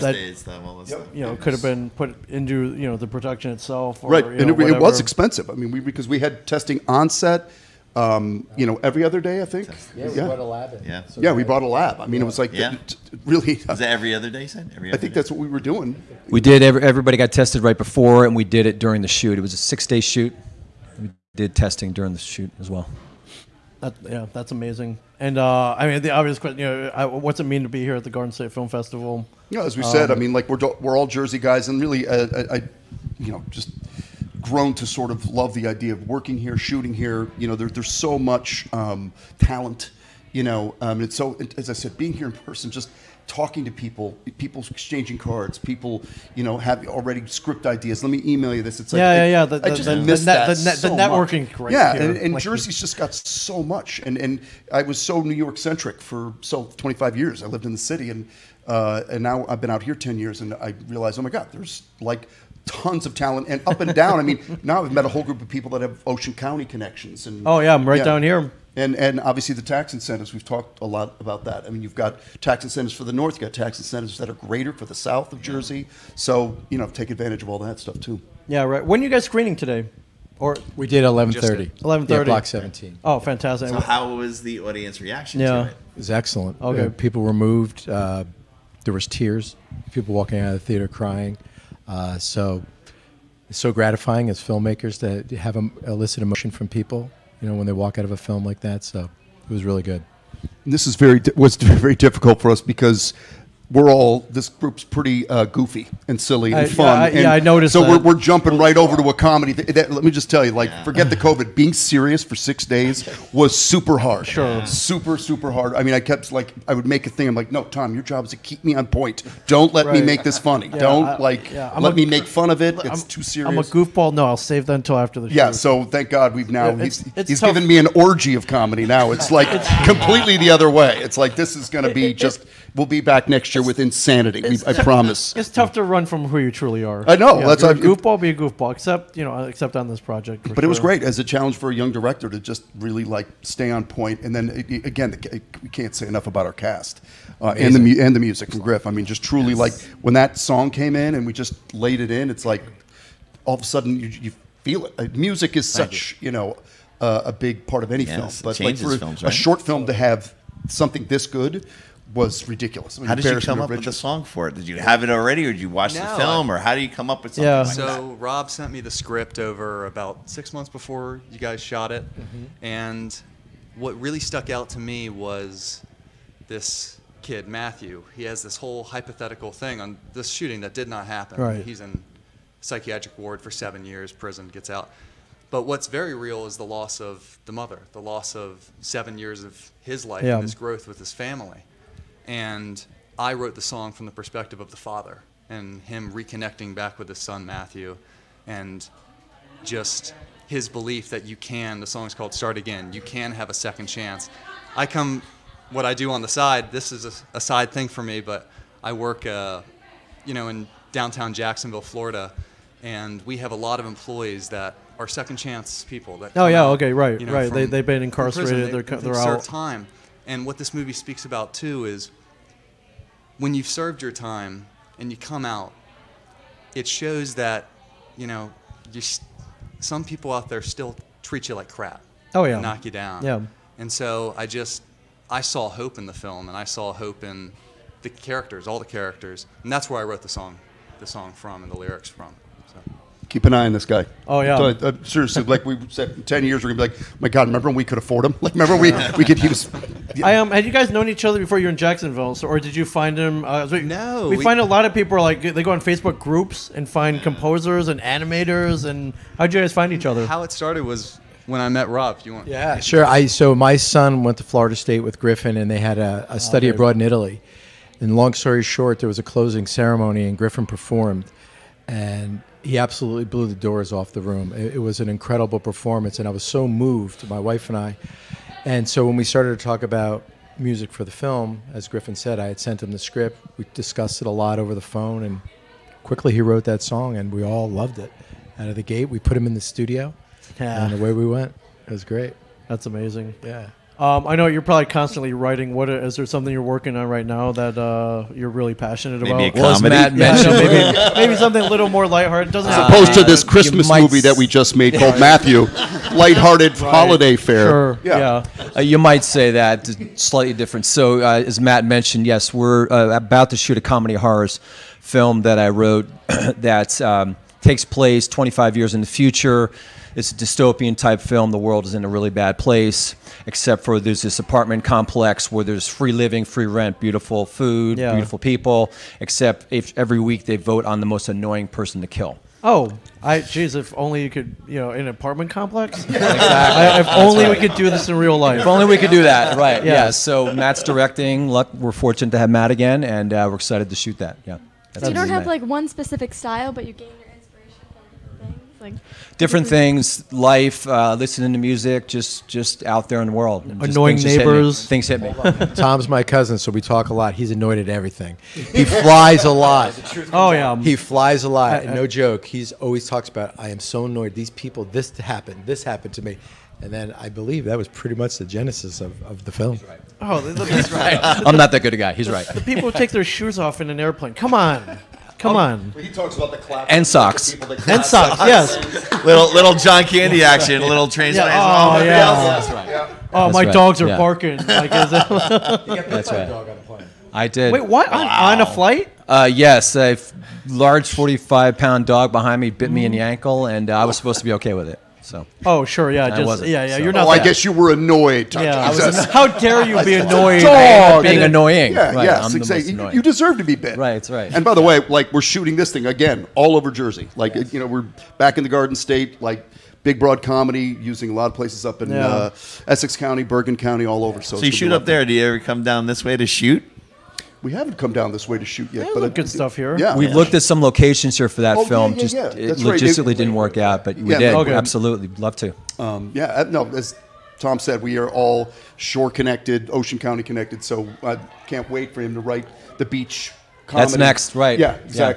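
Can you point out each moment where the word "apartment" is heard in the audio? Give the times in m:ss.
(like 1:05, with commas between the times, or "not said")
5:24, 5:35.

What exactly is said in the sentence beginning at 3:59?
And that's where I wrote the song the song from and the lyrics from.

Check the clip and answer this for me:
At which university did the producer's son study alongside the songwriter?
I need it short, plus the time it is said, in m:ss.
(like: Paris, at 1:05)
Florida State, at 4:24.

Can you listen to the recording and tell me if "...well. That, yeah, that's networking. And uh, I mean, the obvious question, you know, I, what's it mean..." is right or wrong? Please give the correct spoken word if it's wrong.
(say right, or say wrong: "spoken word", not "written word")
wrong: "amazing", not "networking".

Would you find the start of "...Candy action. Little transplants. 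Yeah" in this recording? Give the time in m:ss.
6:20.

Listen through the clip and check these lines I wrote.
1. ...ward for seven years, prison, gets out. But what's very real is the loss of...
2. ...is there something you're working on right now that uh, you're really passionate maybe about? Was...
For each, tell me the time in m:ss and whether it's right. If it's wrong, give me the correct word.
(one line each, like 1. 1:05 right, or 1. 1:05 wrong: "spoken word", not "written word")
1. 3:03 right
2. 4:55 right.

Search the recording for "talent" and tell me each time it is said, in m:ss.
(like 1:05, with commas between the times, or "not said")
0:39, 1:03.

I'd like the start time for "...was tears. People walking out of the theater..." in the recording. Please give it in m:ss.
1:28.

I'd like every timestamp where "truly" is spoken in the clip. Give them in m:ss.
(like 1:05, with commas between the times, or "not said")
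2:16, 2:29.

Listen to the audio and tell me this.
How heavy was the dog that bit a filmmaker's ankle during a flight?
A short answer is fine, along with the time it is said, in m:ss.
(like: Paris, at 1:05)
45 pounds, at 6:31.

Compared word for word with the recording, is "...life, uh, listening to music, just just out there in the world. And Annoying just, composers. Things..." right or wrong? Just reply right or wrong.
wrong.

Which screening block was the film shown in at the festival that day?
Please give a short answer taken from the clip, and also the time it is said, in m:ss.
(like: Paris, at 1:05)
Block 17, at 1:22.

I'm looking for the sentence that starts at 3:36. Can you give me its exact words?
That oh, yeah, out, okay, right, you know, right.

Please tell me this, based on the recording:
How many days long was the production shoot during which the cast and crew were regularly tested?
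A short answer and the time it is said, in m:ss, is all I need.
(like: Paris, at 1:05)
6, at 0:19.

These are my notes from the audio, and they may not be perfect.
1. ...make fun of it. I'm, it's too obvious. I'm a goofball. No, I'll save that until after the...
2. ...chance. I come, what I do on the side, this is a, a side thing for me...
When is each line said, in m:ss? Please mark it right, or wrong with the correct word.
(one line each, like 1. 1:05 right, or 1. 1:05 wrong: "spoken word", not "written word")
1. 2:02 wrong: "serious", not "obvious"
2. 3:23 right.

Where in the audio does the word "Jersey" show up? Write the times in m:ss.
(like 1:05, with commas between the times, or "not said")
0:31, 0:52, 1:15, 6:46.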